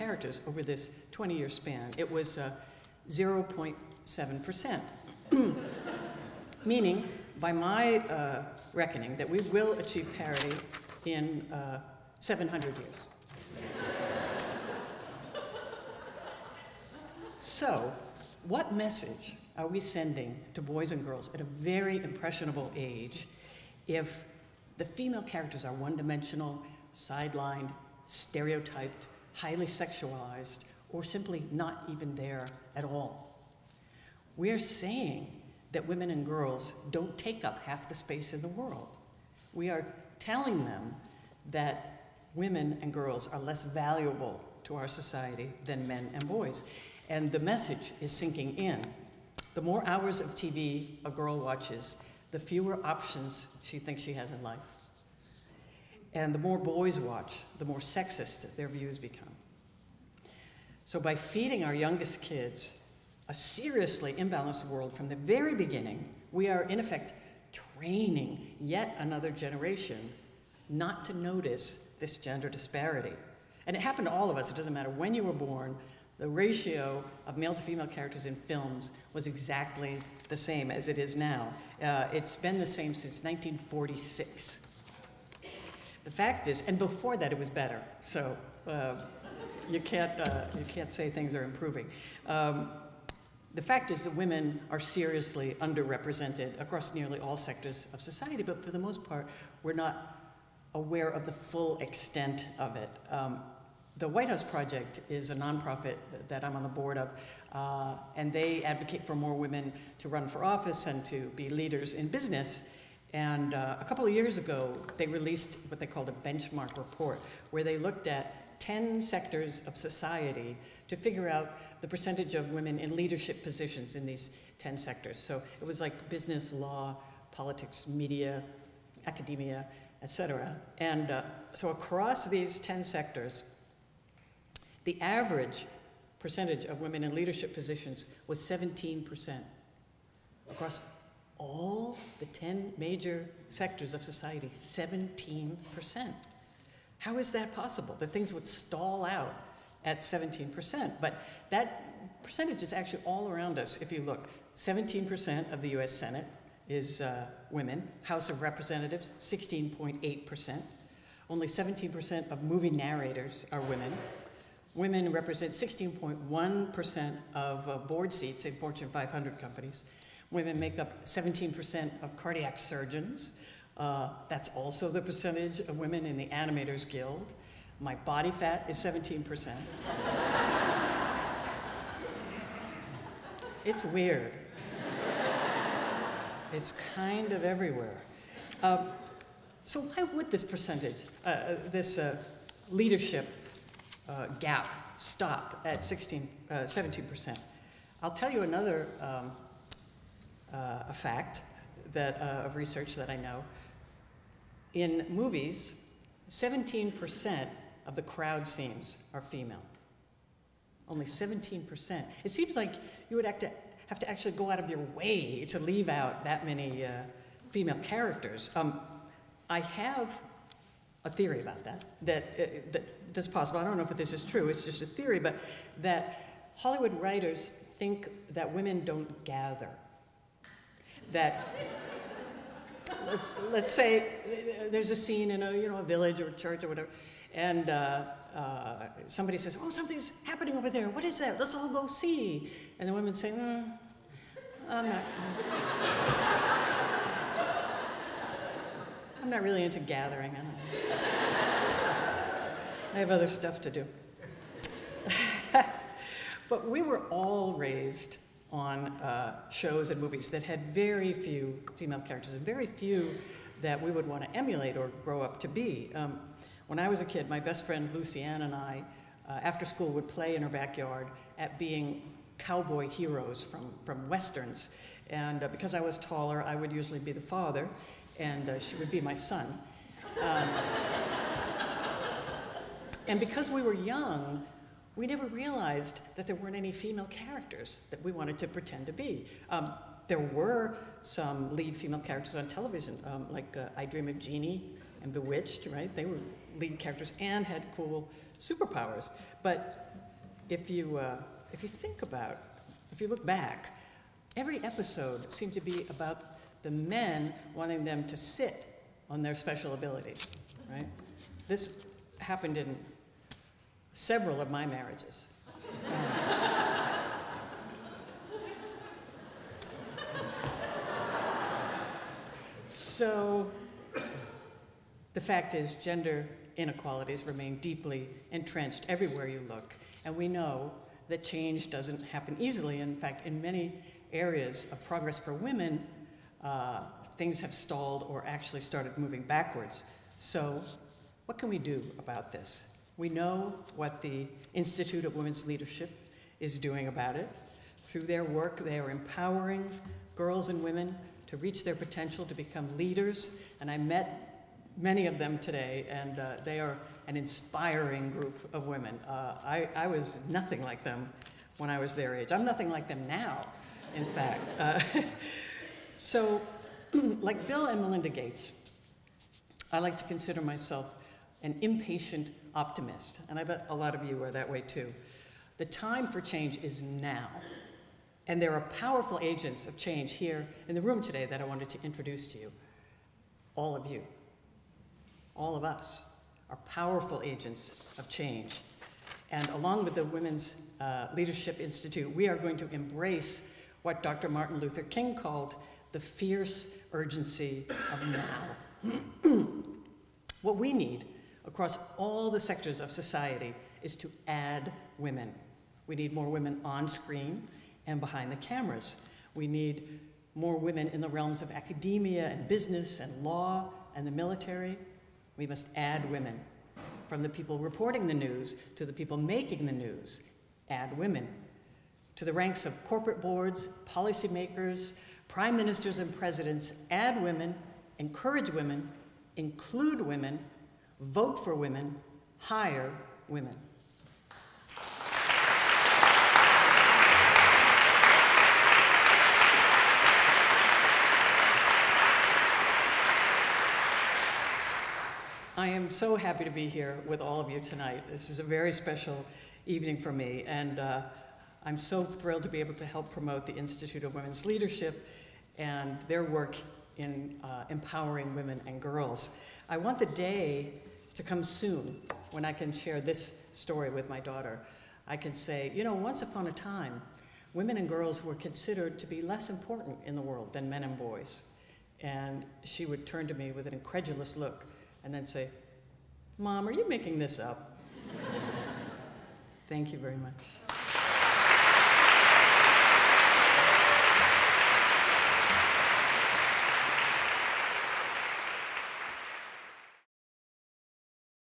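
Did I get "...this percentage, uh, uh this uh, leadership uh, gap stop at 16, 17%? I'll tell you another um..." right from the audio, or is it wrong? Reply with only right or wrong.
right.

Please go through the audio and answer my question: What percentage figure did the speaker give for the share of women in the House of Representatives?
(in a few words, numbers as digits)
16.8%.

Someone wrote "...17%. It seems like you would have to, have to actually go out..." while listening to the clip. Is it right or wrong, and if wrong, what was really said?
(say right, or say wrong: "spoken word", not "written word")
right.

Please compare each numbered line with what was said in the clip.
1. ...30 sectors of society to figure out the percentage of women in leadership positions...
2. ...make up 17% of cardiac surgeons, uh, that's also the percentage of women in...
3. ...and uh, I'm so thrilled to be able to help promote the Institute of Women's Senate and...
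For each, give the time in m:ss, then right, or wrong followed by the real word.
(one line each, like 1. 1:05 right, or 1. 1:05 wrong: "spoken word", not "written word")
1. 1:58 wrong: "10", not "30"
2. 2:50 right
3. 7:30 wrong: "Leadership", not "Senate".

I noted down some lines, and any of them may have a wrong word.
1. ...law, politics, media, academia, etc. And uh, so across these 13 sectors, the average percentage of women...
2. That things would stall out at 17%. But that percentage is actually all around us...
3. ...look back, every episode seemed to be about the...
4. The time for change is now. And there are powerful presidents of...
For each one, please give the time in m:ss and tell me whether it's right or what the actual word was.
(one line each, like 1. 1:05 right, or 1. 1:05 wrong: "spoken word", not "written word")
1. 2:06 wrong: "10", not "13"
2. 2:27 right
3. 5:03 right
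4. 6:15 wrong: "agents", not "presidents".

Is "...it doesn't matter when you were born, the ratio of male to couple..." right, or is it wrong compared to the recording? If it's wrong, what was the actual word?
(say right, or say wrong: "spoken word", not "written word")
wrong: "female", not "couple".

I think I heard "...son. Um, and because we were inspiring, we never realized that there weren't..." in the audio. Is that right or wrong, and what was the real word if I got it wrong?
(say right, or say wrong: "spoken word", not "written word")
wrong: "young", not "inspiring".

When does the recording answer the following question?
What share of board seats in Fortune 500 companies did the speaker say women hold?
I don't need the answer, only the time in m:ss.
2:45.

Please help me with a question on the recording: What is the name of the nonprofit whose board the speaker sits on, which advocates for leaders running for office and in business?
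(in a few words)
White House Project.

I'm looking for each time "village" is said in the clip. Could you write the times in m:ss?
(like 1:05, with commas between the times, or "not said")
3:55.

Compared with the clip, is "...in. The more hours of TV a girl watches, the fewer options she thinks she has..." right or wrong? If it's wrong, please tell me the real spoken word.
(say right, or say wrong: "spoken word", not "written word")
right.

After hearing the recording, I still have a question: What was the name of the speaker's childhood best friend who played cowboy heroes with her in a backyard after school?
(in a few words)
Lucianne.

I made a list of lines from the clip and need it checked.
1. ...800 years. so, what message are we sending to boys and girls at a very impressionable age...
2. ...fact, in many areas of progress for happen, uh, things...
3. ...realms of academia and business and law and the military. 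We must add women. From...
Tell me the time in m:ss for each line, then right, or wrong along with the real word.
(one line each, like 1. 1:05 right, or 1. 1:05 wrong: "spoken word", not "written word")
1. 0:12 wrong: "700", not "800"
2. 5:32 wrong: "women", not "happen"
3. 6:51 right.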